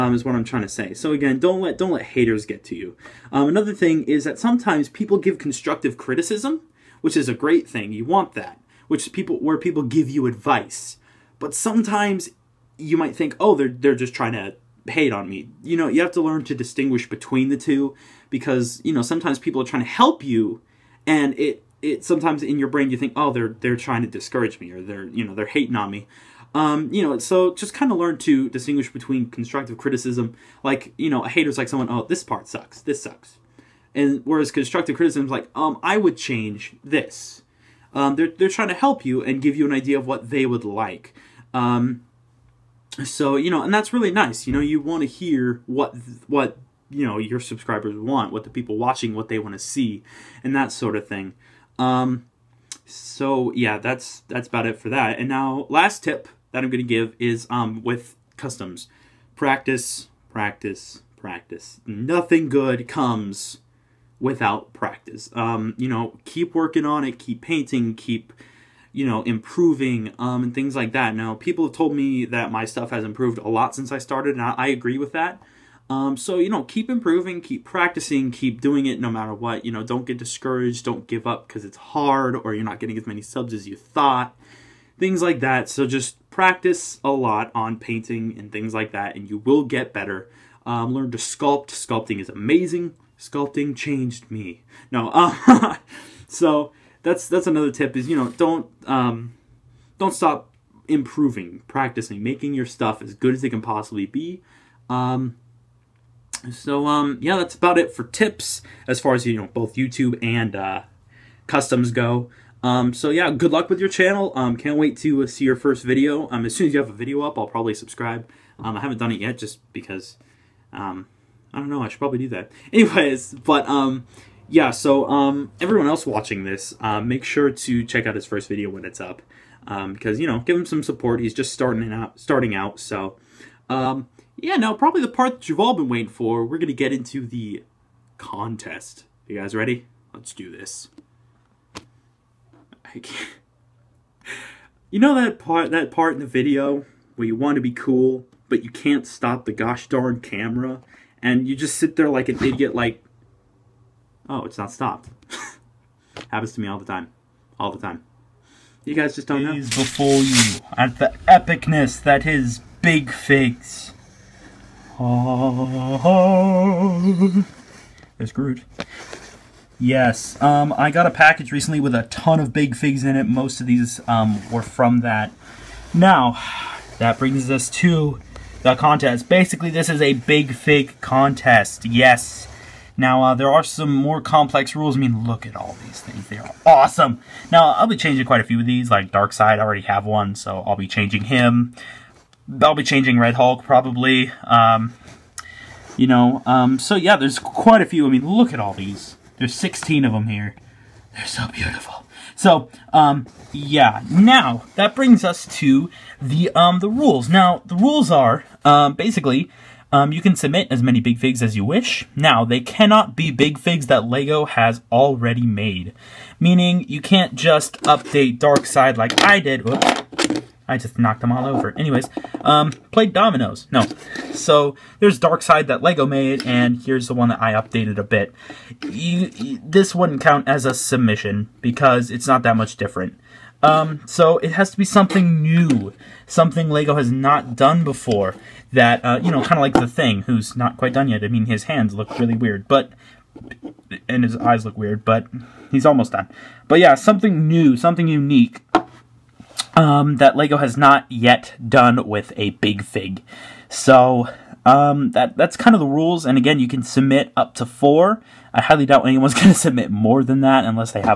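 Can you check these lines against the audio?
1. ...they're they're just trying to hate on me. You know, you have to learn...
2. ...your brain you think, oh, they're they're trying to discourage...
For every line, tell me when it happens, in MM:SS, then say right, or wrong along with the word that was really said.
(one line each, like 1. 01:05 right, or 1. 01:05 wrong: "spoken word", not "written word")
1. 00:13 right
2. 00:22 right.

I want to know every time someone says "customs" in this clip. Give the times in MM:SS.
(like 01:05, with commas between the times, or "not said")
00:58, 01:51.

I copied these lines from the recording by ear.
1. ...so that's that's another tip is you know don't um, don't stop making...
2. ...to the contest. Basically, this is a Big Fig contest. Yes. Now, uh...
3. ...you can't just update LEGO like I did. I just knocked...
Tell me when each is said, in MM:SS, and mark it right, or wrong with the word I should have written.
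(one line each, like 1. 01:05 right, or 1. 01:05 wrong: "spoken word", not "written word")
1. 01:36 wrong: "improving", not "making"
2. 02:57 right
3. 03:36 wrong: "Darkseid", not "LEGO".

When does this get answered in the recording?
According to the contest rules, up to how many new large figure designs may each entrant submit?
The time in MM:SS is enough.
04:17.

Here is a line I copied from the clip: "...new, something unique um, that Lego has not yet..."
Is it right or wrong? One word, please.
right.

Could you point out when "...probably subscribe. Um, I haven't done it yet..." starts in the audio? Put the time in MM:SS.
01:57.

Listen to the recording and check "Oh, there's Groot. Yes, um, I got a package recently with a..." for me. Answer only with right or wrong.
right.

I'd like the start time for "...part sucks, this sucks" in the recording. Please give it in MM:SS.
00:32.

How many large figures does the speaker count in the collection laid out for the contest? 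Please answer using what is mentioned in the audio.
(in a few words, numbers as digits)
16.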